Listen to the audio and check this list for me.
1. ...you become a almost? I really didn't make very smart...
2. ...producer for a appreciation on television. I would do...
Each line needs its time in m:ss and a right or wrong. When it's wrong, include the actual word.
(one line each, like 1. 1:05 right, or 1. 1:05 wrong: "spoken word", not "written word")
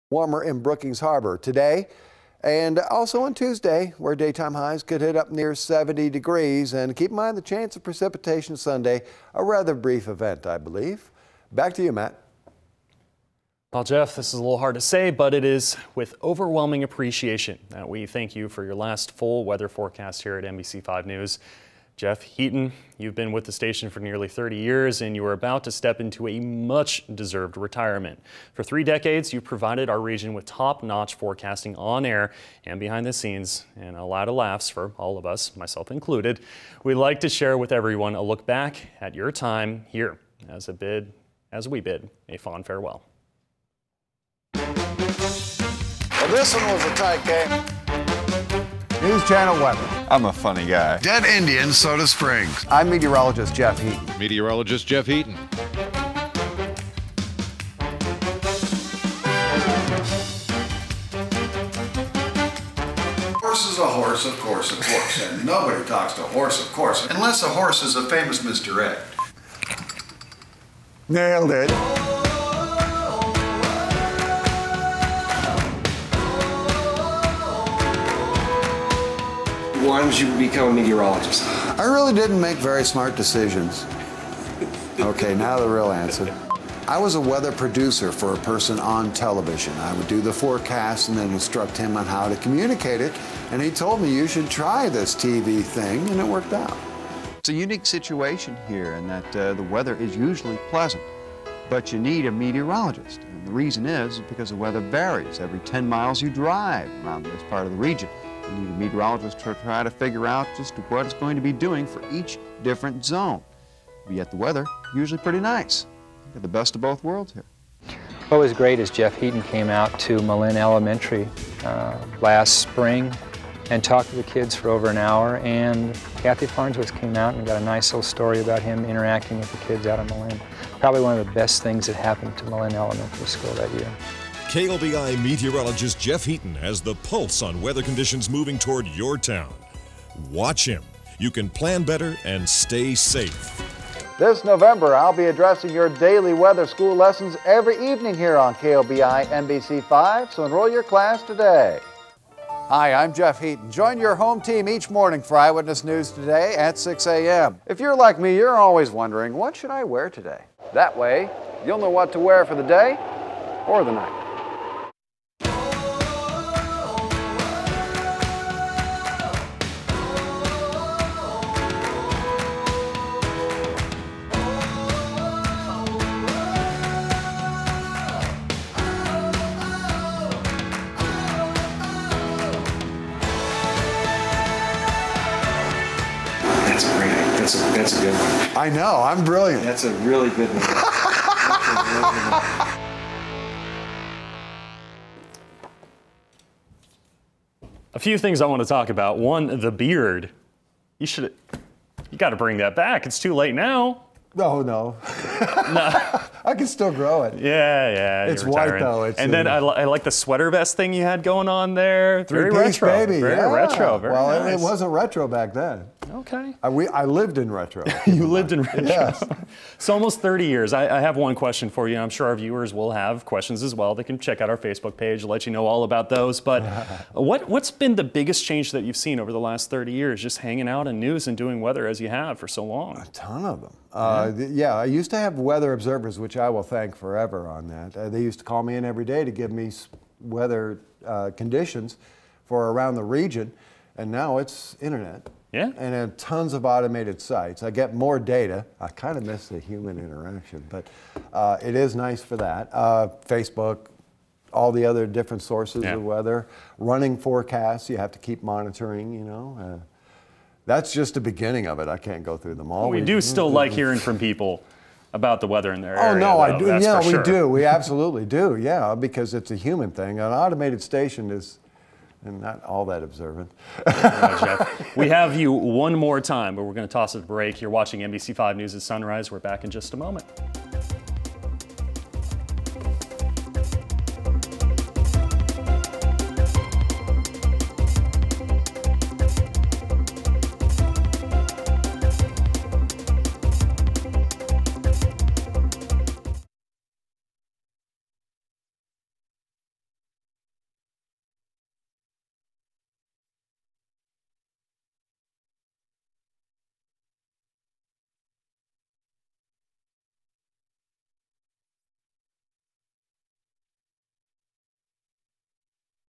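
1. 1:20 wrong: "meteorologist", not "almost"
2. 1:27 wrong: "person", not "appreciation".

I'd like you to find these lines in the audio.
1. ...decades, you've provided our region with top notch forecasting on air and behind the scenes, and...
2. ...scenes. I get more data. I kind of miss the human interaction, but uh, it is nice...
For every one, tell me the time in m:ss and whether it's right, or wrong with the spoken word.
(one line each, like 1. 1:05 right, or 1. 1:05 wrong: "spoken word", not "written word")
1. 0:28 right
2. 4:07 wrong: "sites", not "scenes".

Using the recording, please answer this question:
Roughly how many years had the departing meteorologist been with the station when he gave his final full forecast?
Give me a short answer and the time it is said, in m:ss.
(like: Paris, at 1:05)
30 years, at 0:23.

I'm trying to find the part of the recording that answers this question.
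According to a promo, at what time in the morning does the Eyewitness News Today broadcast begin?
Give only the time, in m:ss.
2:36.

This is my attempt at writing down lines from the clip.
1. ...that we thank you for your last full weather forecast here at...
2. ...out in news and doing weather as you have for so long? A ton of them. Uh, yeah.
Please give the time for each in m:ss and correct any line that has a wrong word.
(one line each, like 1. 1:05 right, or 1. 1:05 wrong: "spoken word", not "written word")
1. 0:17 right
2. 3:50 right.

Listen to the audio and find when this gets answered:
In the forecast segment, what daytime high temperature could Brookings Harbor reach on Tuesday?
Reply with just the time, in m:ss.
0:05.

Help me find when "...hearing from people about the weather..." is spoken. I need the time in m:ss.
4:23.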